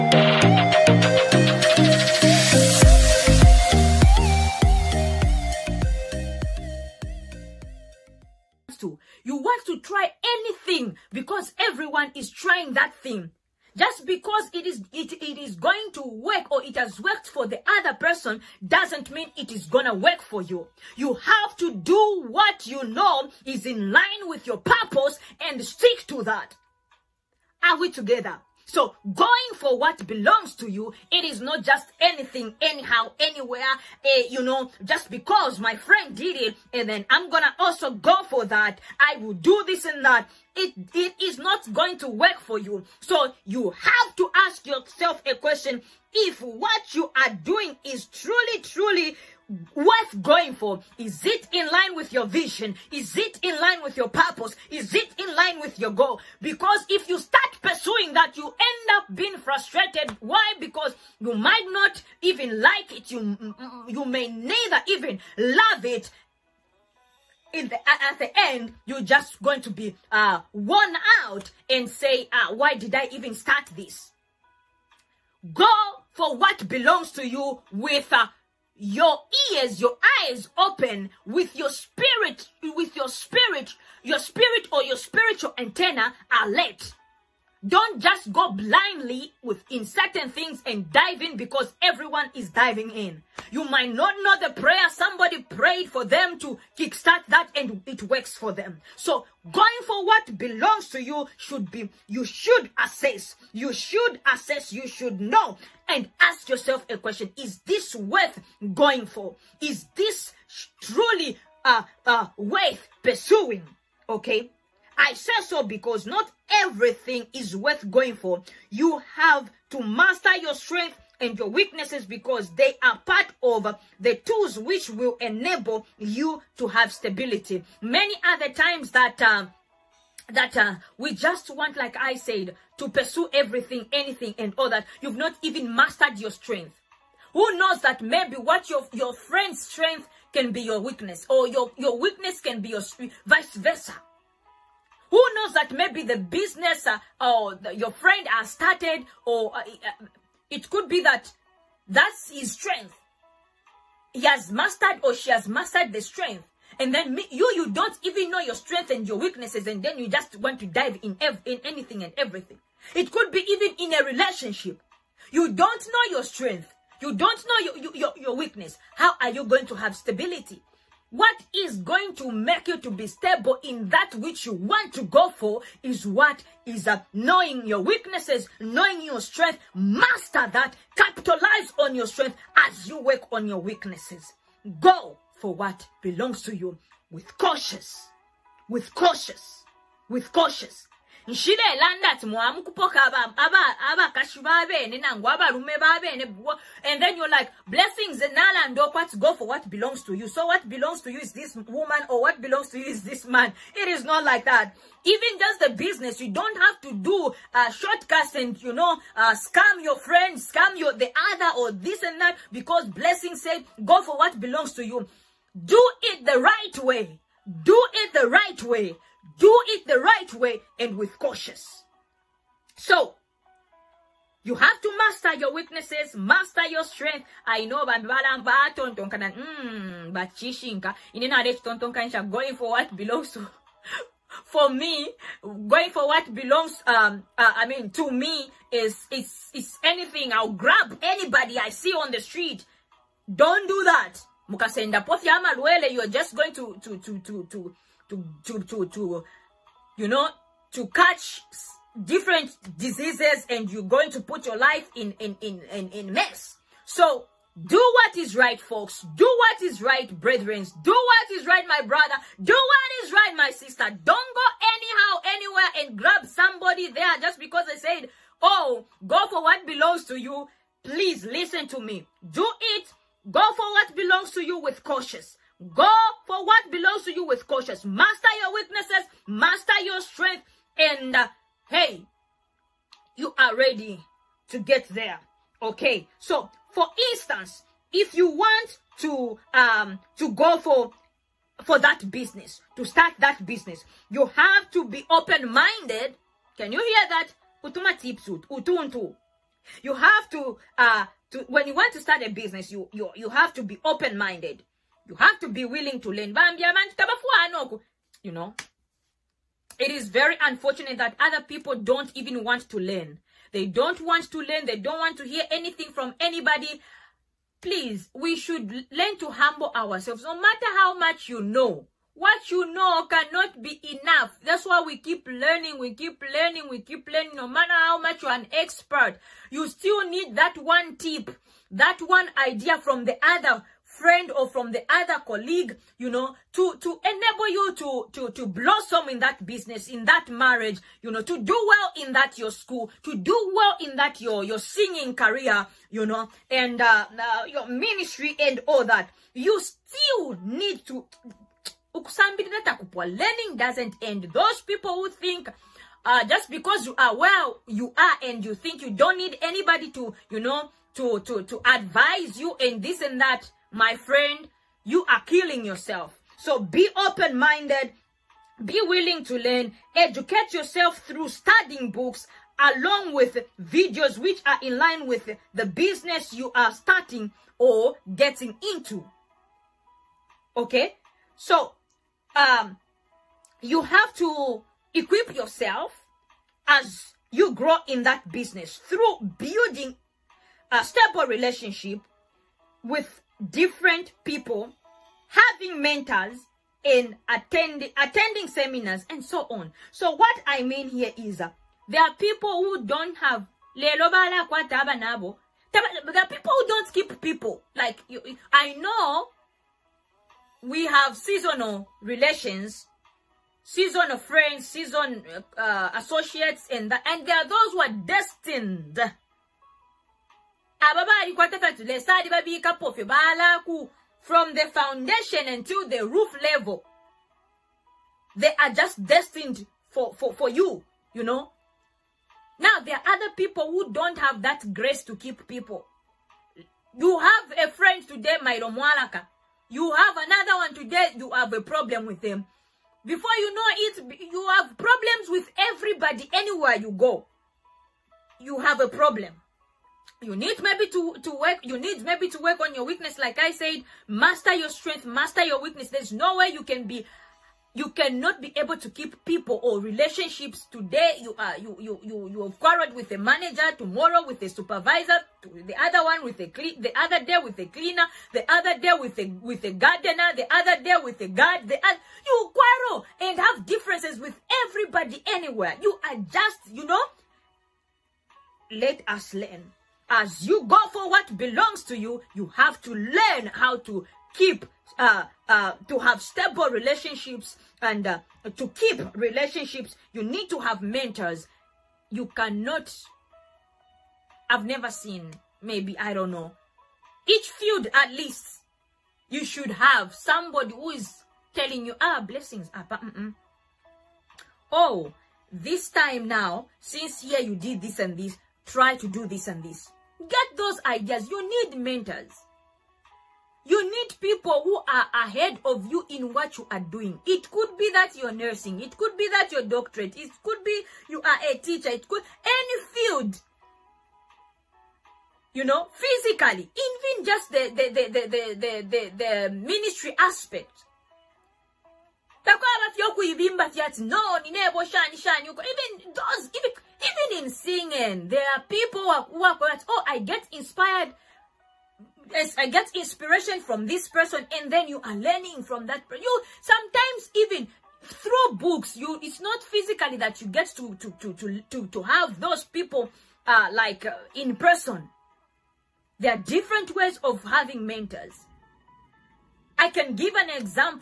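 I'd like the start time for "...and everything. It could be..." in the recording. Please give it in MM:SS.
02:42.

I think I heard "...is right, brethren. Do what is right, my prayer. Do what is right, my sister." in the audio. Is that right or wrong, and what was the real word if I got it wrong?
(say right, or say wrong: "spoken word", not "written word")
wrong: "brother", not "prayer".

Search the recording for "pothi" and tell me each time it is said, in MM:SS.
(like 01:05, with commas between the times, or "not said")
04:05.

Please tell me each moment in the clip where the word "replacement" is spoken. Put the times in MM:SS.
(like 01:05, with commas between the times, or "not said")
not said.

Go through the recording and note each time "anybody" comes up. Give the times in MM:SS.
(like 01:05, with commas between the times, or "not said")
04:01, 05:16, 05:59.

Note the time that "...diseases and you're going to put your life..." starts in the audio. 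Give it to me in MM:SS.
04:12.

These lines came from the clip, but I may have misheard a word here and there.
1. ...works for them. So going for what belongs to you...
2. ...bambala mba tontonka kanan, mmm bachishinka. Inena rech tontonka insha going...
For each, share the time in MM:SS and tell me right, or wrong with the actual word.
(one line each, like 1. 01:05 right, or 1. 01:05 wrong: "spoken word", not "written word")
1. 01:38 right
2. 03:47 right.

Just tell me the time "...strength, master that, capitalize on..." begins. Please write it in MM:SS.
02:59.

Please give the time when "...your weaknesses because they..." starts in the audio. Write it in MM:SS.
02:01.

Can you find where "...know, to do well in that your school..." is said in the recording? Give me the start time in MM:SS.
05:41.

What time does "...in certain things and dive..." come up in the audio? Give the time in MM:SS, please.
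01:29.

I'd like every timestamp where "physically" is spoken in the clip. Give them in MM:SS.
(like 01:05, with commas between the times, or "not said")
08:45, 09:09.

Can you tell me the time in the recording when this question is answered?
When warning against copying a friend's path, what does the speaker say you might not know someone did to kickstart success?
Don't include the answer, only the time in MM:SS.
01:34.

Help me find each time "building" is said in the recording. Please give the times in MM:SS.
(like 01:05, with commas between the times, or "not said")
06:29.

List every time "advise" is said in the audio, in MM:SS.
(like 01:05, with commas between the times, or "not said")
06:01.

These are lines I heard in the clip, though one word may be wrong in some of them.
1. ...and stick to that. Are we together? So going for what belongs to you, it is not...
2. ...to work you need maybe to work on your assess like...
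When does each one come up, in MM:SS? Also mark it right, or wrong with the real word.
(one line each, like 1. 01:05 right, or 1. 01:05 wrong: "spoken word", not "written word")
1. 00:25 right
2. 07:31 wrong: "weakness", not "assess".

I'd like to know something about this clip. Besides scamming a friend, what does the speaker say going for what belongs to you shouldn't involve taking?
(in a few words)
shortcuts.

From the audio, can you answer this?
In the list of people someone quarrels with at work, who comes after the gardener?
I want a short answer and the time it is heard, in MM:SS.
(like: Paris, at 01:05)
the guard, at 07:51.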